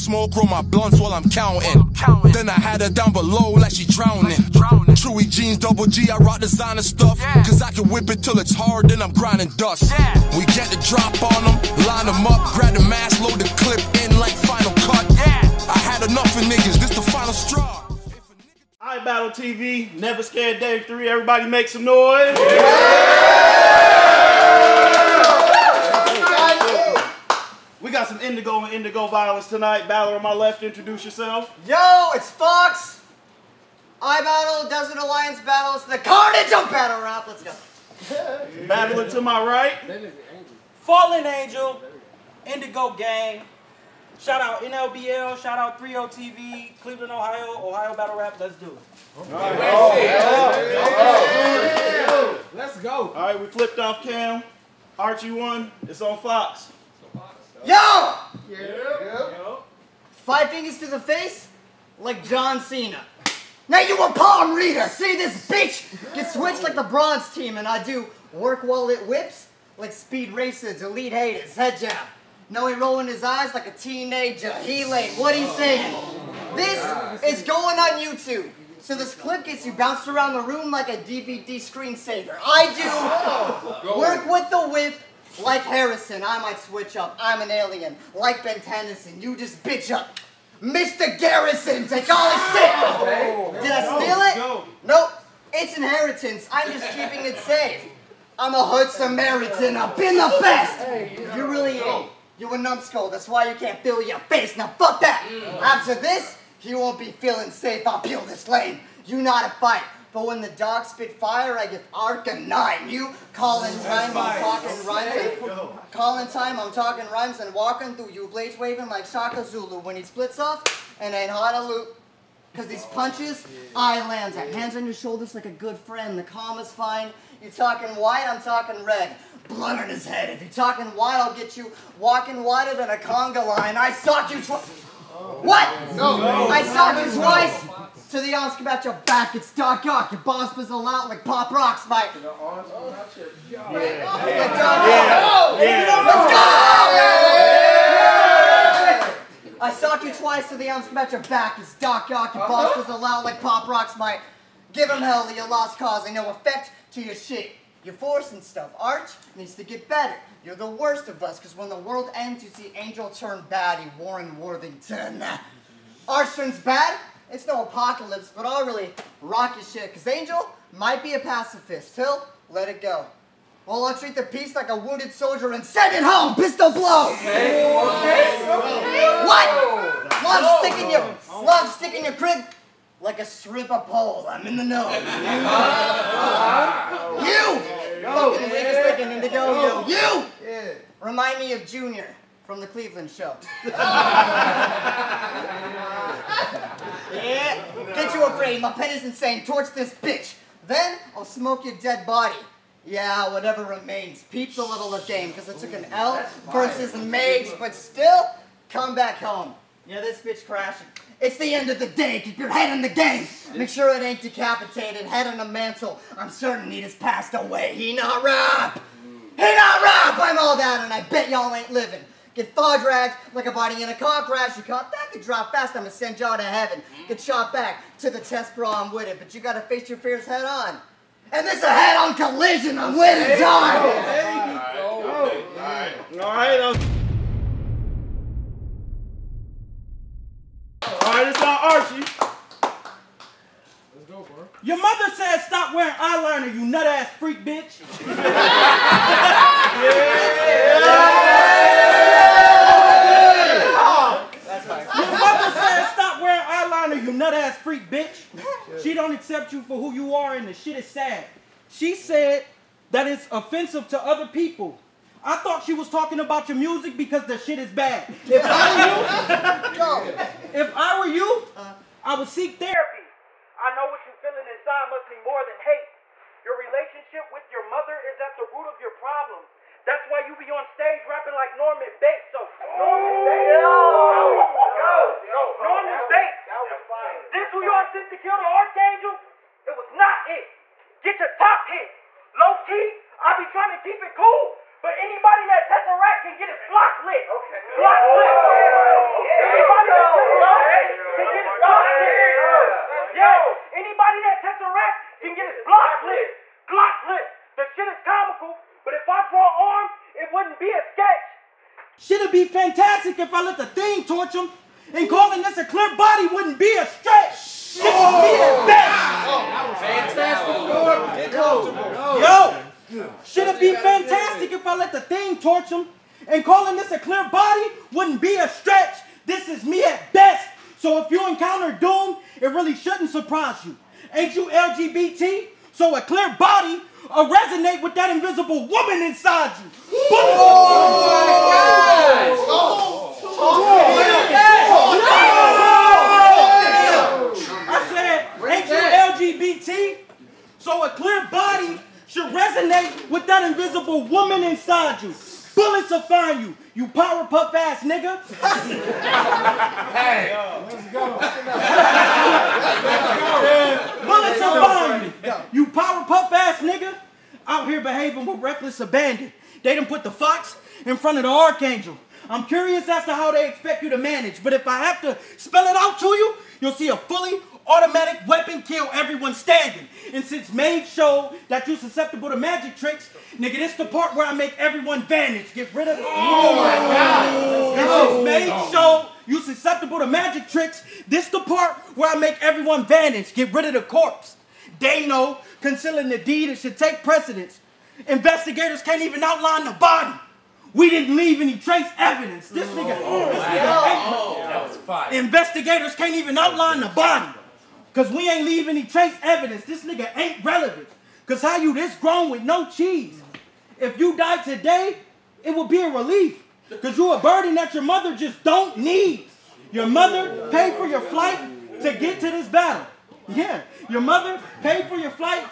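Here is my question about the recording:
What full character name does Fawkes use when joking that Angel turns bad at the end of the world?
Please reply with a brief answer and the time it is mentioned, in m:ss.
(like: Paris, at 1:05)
Warren Worthington, at 2:43.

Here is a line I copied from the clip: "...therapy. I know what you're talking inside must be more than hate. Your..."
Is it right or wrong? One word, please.
wrong.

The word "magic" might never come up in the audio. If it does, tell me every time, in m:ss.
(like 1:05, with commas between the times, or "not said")
6:22, 6:30.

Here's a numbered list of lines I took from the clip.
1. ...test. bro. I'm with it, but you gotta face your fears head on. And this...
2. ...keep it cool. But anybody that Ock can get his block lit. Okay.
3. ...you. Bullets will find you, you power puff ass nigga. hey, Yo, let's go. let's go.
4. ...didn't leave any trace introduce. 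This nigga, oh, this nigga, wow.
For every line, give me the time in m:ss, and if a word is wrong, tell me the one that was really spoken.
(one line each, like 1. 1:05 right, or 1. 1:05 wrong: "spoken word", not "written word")
1. 3:48 right
2. 4:53 wrong: "Tesseract", not "Ock"
3. 5:55 right
4. 6:40 wrong: "evidence", not "introduce".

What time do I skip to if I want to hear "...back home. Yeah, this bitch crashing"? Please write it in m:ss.
3:28.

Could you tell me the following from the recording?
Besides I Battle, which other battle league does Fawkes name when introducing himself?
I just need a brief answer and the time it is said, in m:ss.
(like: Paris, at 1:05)
Desert Alliance Battles, at 0:34.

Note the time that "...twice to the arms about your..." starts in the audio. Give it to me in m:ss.
2:30.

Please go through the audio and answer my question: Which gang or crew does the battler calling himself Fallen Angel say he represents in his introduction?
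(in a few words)
Indigo Gang.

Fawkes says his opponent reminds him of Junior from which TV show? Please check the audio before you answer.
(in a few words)
The Cleveland Show.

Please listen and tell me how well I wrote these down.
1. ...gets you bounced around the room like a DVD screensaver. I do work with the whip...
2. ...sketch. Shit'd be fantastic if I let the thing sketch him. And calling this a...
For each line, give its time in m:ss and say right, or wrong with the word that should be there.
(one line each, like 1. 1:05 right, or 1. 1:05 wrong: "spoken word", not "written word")
1. 1:19 right
2. 5:10 wrong: "torch", not "sketch".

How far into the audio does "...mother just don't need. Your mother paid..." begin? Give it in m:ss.
6:57.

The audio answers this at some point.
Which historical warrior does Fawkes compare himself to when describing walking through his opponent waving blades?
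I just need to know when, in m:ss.
1:59.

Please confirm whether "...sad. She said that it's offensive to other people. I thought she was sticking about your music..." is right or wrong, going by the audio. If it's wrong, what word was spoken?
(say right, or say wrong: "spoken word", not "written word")
wrong: "talking", not "sticking".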